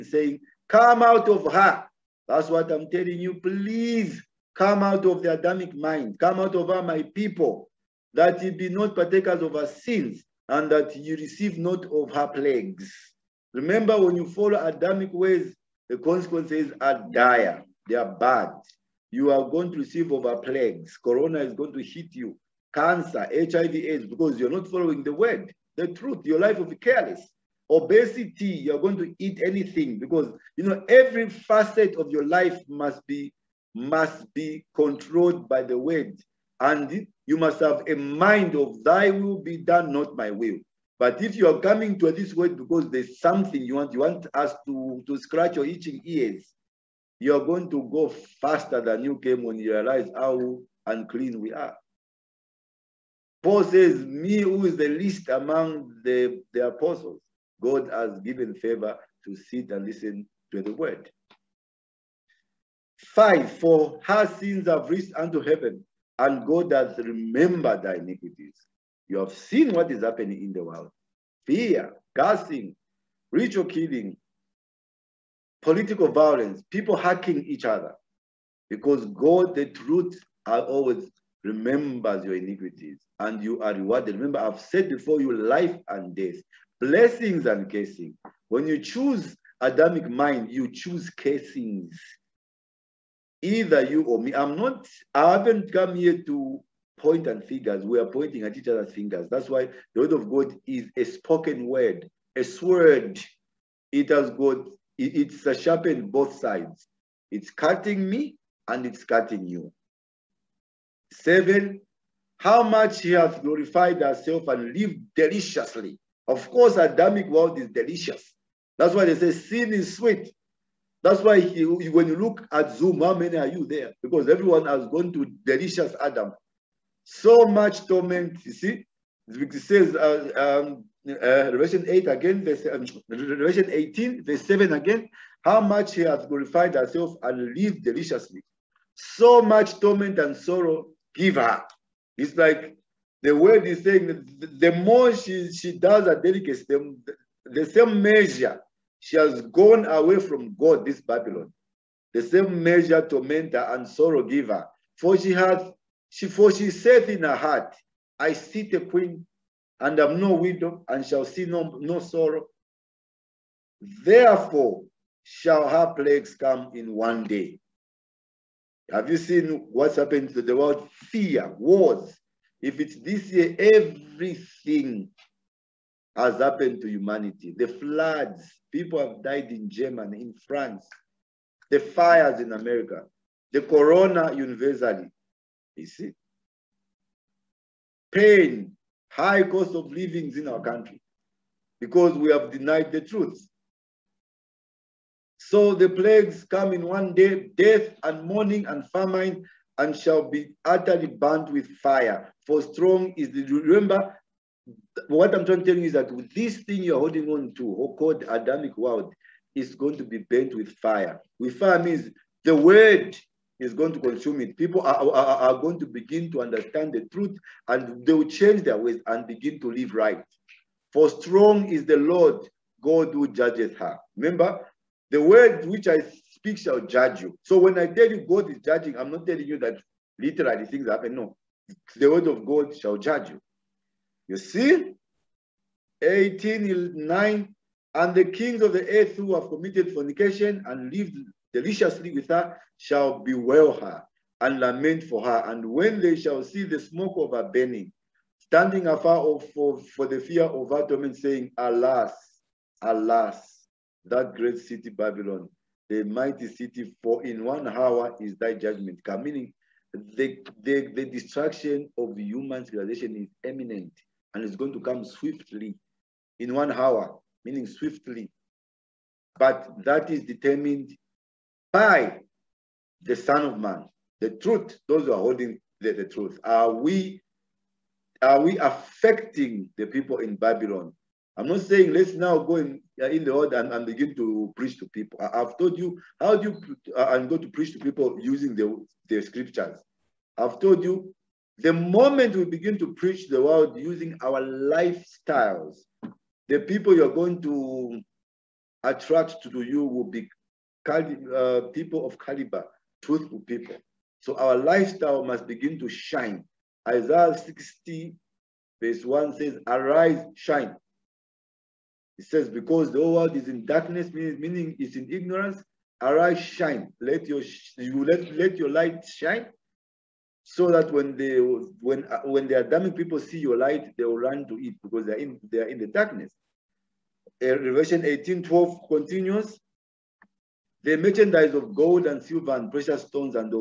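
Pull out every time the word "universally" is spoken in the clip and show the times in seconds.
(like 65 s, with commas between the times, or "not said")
184 s.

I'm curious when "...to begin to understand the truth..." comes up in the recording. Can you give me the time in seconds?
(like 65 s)
215 s.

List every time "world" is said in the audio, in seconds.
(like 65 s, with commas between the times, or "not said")
70 s, 117 s, 170 s, 208 s, 283 s, 293 s, 313 s.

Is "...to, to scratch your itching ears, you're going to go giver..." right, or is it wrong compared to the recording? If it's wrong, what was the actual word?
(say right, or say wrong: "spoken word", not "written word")
wrong: "faster", not "giver".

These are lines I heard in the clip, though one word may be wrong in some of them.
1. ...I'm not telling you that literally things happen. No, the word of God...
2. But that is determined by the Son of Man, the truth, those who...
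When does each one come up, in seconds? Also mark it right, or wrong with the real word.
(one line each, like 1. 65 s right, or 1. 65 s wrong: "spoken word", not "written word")
1. 228 s right
2. 269 s right.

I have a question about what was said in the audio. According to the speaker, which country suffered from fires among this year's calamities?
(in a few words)
America.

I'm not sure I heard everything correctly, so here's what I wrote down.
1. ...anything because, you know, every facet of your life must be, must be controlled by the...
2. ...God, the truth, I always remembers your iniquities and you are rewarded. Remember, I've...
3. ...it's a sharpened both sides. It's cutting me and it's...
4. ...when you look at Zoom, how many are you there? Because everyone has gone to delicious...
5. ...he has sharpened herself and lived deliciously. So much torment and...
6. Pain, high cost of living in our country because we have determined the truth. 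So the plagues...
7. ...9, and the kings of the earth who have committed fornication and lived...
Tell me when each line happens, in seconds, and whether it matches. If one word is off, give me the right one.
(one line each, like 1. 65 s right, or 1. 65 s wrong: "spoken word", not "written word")
1. 29 s right
2. 79 s right
3. 105 s right
4. 121 s right
5. 135 s wrong: "glorified", not "sharpened"
6. 188 s wrong: "denied", not "determined"
7. 237 s right.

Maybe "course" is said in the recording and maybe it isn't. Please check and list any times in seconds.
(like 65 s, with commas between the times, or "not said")
116 s.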